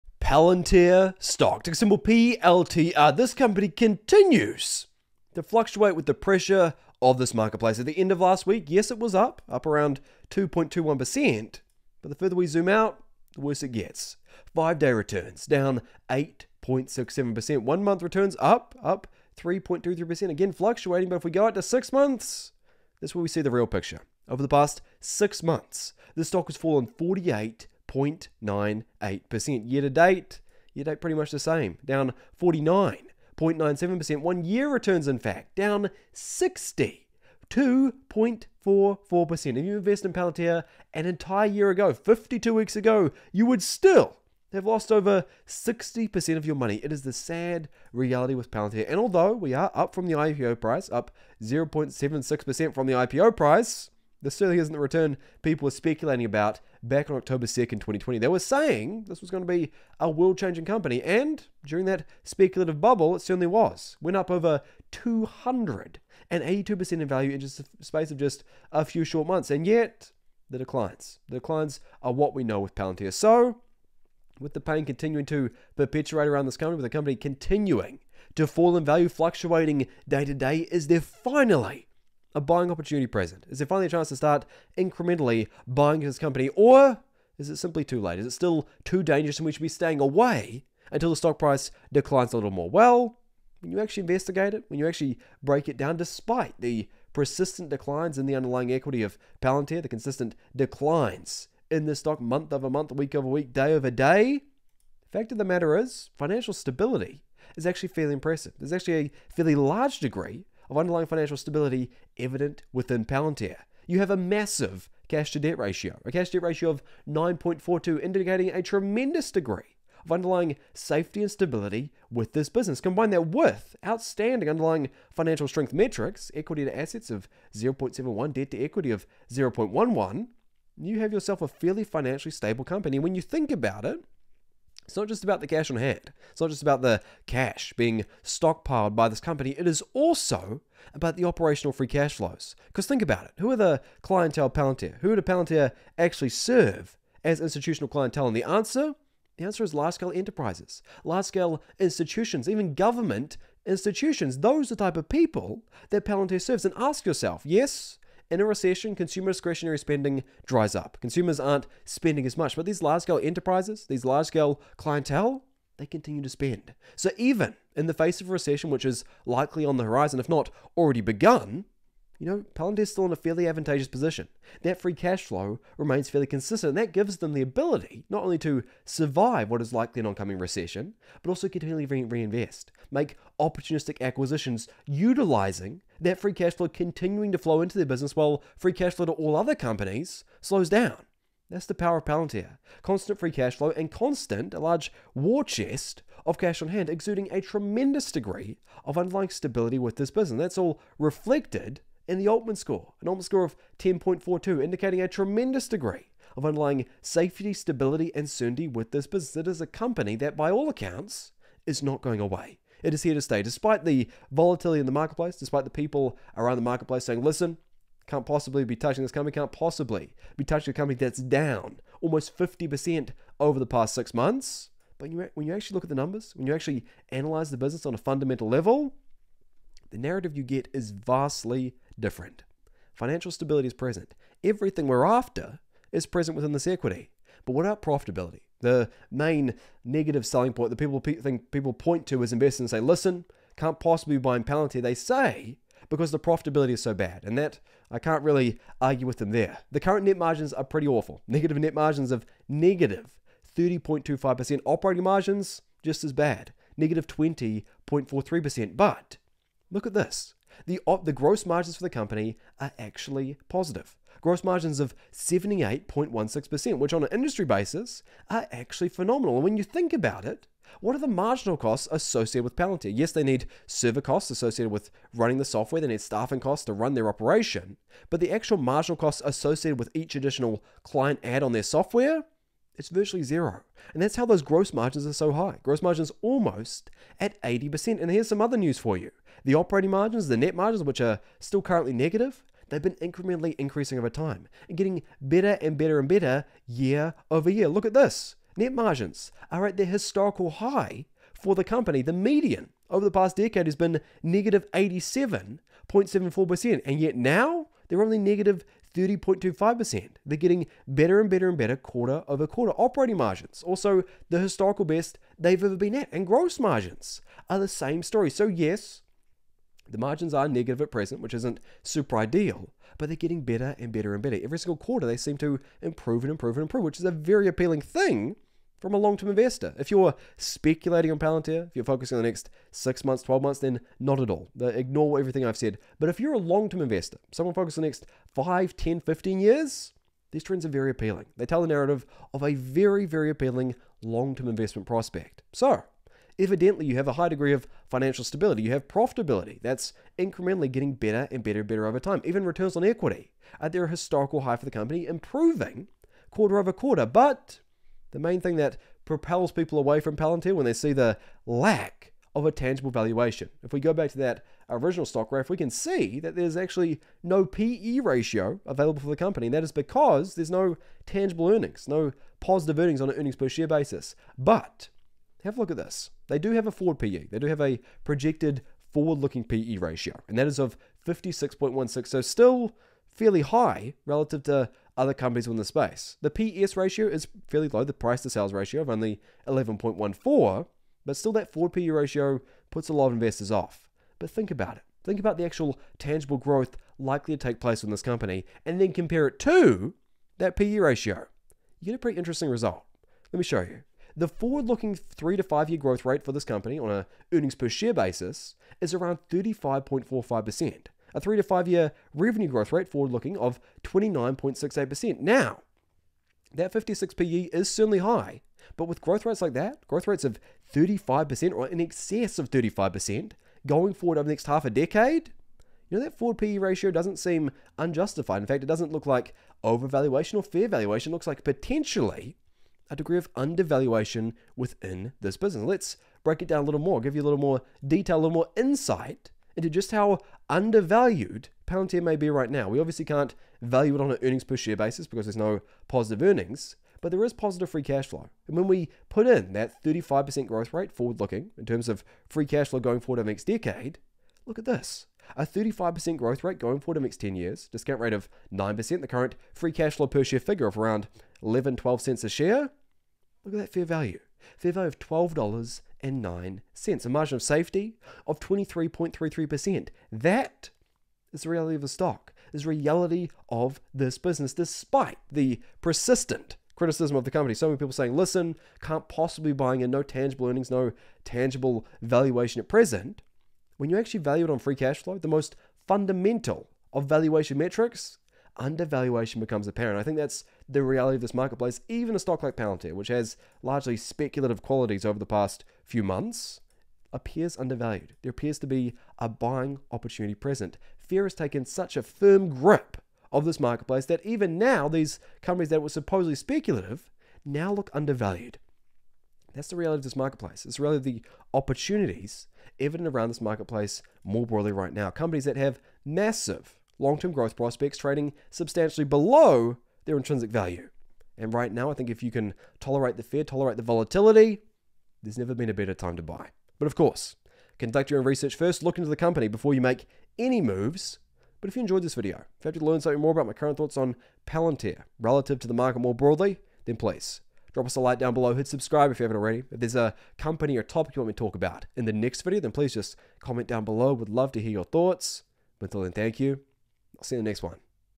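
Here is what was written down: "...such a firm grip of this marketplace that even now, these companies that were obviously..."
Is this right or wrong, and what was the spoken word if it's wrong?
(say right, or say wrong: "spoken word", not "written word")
wrong: "supposedly", not "obviously".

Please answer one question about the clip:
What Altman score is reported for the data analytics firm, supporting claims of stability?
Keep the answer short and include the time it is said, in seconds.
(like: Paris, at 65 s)
10.42, at 203 s.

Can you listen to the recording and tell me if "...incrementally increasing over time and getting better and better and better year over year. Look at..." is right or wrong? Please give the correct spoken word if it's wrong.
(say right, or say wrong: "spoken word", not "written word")
right.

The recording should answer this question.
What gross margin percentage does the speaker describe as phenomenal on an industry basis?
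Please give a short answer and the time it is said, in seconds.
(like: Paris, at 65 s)
78.16%, at 265 s.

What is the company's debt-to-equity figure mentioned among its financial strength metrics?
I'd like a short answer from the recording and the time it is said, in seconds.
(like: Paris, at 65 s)
0.11, at 129 s.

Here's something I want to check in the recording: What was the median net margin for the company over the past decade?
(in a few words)
-87.74%.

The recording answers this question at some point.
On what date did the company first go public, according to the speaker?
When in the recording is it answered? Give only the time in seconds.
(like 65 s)
57 s.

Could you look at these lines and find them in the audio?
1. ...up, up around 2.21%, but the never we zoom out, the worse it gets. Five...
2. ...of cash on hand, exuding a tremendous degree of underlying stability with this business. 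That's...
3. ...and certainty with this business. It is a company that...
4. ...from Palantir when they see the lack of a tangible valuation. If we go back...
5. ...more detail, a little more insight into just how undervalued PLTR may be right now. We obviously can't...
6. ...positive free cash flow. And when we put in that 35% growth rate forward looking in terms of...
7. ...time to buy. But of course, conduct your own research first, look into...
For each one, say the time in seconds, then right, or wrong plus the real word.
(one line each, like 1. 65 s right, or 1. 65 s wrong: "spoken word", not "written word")
1. 9 s wrong: "further", not "never"
2. 196 s right
3. 208 s right
4. 359 s right
5. 437 s wrong: "Palantir", not "PLTR"
6. 447 s right
7. 525 s right.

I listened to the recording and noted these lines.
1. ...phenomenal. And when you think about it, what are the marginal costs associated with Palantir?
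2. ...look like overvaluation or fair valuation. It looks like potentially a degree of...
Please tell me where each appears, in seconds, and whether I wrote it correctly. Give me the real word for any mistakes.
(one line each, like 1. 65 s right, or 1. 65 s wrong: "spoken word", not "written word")
1. 268 s right
2. 428 s right.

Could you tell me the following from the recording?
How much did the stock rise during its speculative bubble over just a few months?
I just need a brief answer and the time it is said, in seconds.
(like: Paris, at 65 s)
282%, at 64 s.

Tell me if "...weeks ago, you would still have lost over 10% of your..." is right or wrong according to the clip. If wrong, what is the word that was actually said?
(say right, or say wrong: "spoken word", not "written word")
wrong: "60", not "10".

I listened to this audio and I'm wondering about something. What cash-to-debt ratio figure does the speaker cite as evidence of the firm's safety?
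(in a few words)
9.42.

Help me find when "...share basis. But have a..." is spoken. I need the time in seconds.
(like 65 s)
373 s.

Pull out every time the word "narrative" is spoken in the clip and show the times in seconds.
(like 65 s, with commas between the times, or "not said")
229 s, 341 s.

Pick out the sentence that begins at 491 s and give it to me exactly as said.
Even a stock like Palantir, which has largely speculative qualities over the past few months, appears undervalued.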